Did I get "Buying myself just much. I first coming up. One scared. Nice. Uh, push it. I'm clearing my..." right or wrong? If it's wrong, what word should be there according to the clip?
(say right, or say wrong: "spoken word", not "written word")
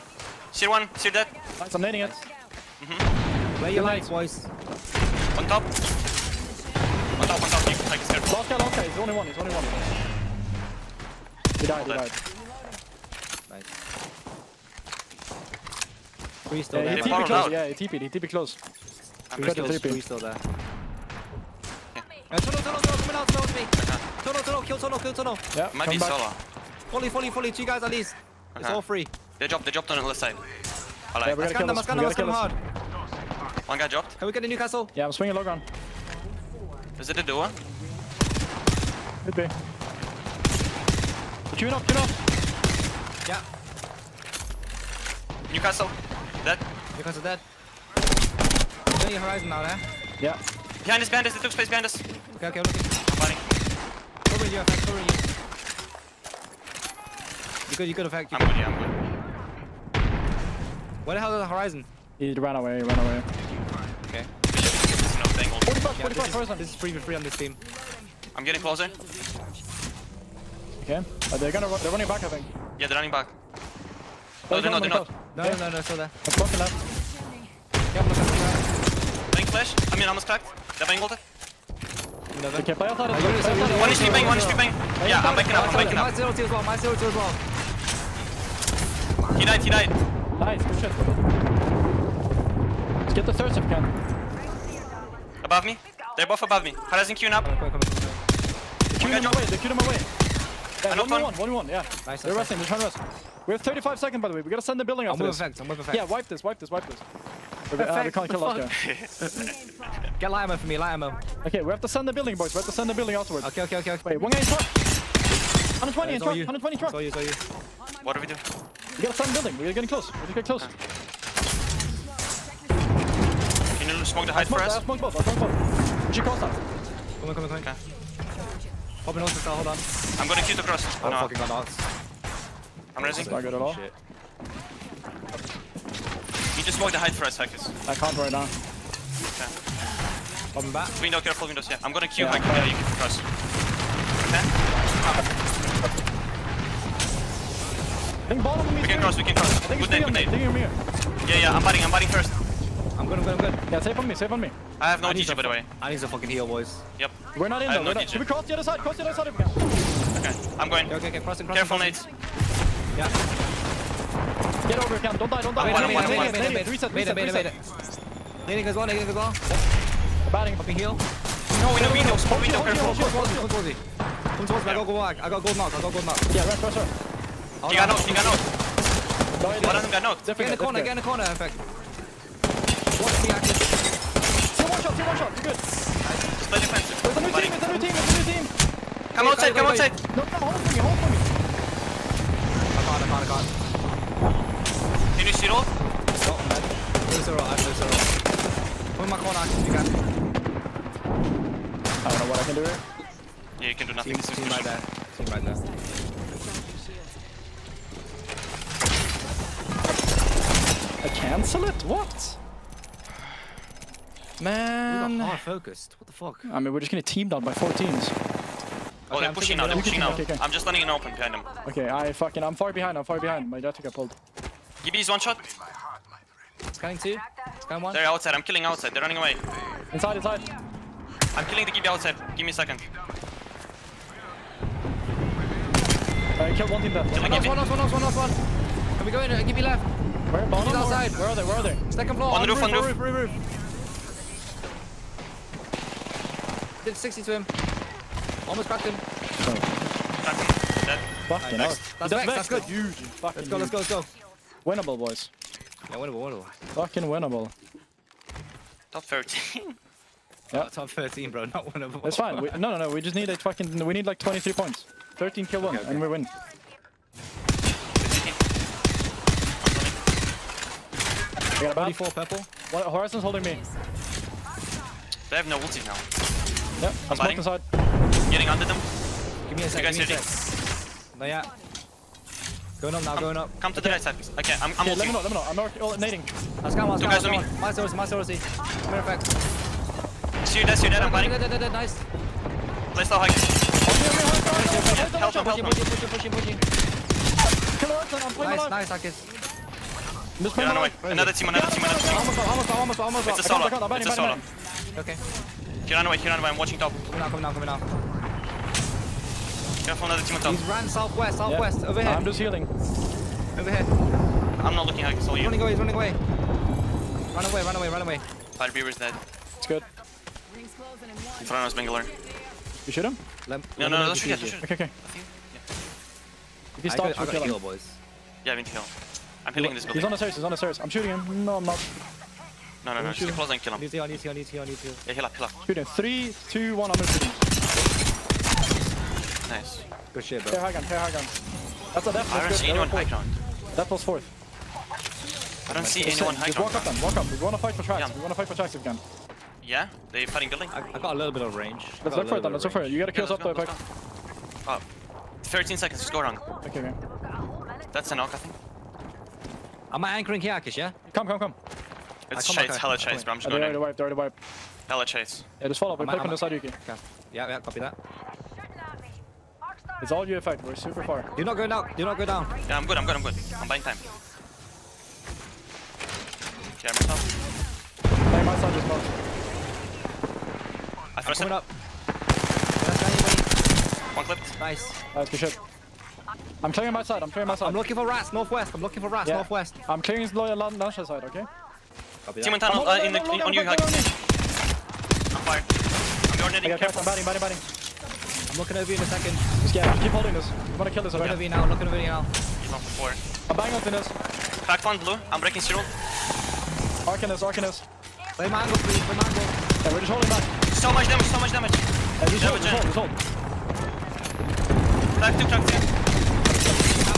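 wrong: "clipped", not "scared".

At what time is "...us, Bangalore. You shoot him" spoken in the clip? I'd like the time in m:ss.
5:21.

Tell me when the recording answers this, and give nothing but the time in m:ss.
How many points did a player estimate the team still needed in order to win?
4:24.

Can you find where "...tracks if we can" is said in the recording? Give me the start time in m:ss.
5:48.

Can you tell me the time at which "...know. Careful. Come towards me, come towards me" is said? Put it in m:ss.
2:52.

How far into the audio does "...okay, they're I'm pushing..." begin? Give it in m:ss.
3:39.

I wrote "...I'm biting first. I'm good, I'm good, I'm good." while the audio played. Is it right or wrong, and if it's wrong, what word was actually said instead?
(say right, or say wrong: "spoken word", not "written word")
right.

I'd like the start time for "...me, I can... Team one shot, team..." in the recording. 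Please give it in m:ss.
3:03.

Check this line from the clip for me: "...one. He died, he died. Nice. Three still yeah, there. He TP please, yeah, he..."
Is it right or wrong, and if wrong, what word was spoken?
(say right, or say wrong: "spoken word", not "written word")
wrong: "close", not "please".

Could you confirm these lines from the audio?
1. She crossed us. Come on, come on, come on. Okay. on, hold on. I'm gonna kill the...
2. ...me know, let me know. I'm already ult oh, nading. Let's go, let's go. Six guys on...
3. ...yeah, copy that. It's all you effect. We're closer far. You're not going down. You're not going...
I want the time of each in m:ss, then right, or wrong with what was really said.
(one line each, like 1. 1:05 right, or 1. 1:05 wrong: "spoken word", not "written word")
1. 2:06 right
2. 4:45 wrong: "Two", not "Six"
3. 6:07 wrong: "super", not "closer".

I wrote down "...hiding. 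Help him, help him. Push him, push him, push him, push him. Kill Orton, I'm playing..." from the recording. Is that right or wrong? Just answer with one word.
right.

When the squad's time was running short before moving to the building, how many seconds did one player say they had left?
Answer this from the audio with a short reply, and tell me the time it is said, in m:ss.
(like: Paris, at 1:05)
35, at 1:43.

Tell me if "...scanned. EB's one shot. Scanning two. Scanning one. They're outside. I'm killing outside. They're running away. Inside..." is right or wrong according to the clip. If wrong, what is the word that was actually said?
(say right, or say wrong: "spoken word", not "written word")
wrong: "pulled", not "scanned".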